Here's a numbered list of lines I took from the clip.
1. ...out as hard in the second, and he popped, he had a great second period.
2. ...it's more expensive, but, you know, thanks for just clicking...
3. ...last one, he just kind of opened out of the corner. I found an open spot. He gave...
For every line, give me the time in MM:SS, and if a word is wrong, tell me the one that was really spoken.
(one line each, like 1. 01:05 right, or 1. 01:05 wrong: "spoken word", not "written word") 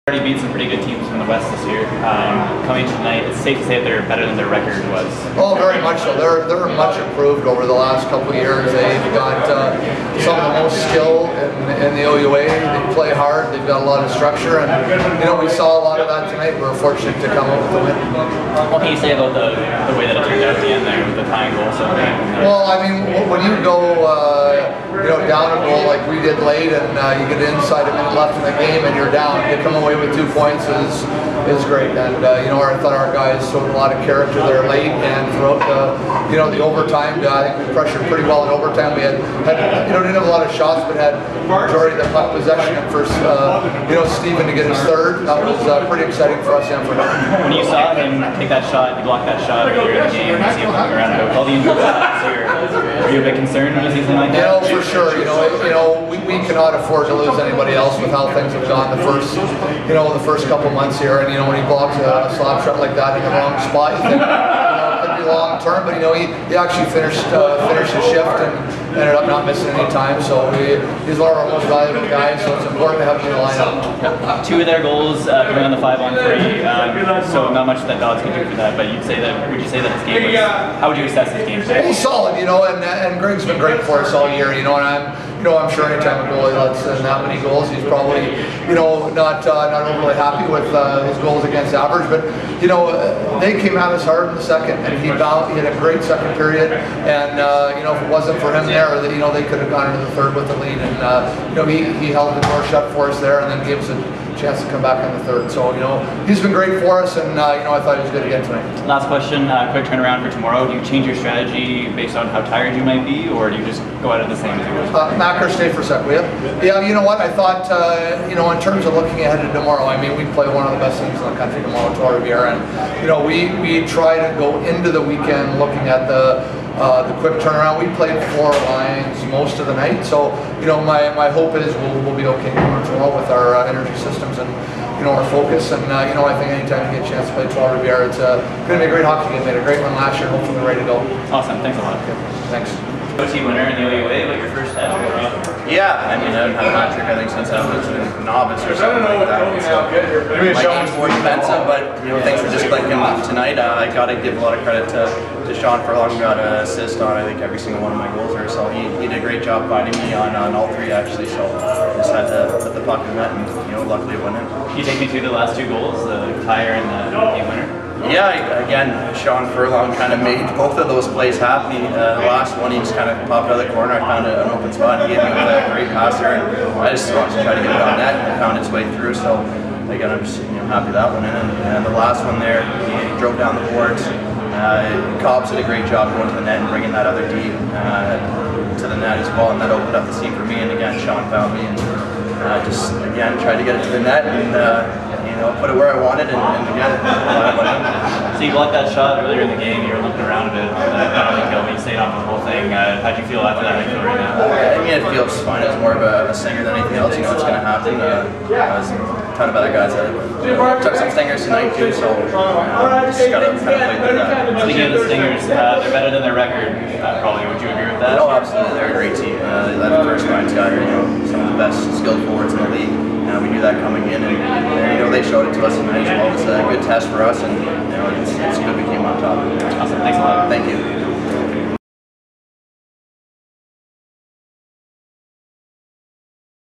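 1. 01:33 wrong: "bowed", not "popped"
2. 02:30 right
3. 02:52 wrong: "popped", not "opened".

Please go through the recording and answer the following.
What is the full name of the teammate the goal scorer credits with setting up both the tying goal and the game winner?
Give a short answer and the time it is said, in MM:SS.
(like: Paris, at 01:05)
Sean Furlong, at 02:49.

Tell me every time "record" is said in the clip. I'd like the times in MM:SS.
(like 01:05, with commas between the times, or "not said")
00:04, 03:36.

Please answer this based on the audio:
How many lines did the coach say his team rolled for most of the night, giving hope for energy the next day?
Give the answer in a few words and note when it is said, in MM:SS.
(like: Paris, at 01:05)
4, at 02:08.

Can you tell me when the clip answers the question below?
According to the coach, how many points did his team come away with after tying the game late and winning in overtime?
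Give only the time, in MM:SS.
00:30.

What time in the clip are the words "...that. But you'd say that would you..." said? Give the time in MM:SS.
01:18.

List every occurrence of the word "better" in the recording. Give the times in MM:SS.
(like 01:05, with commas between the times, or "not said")
00:04, 03:35.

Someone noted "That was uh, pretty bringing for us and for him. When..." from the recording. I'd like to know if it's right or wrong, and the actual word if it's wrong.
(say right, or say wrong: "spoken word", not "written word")
wrong: "exciting", not "bringing".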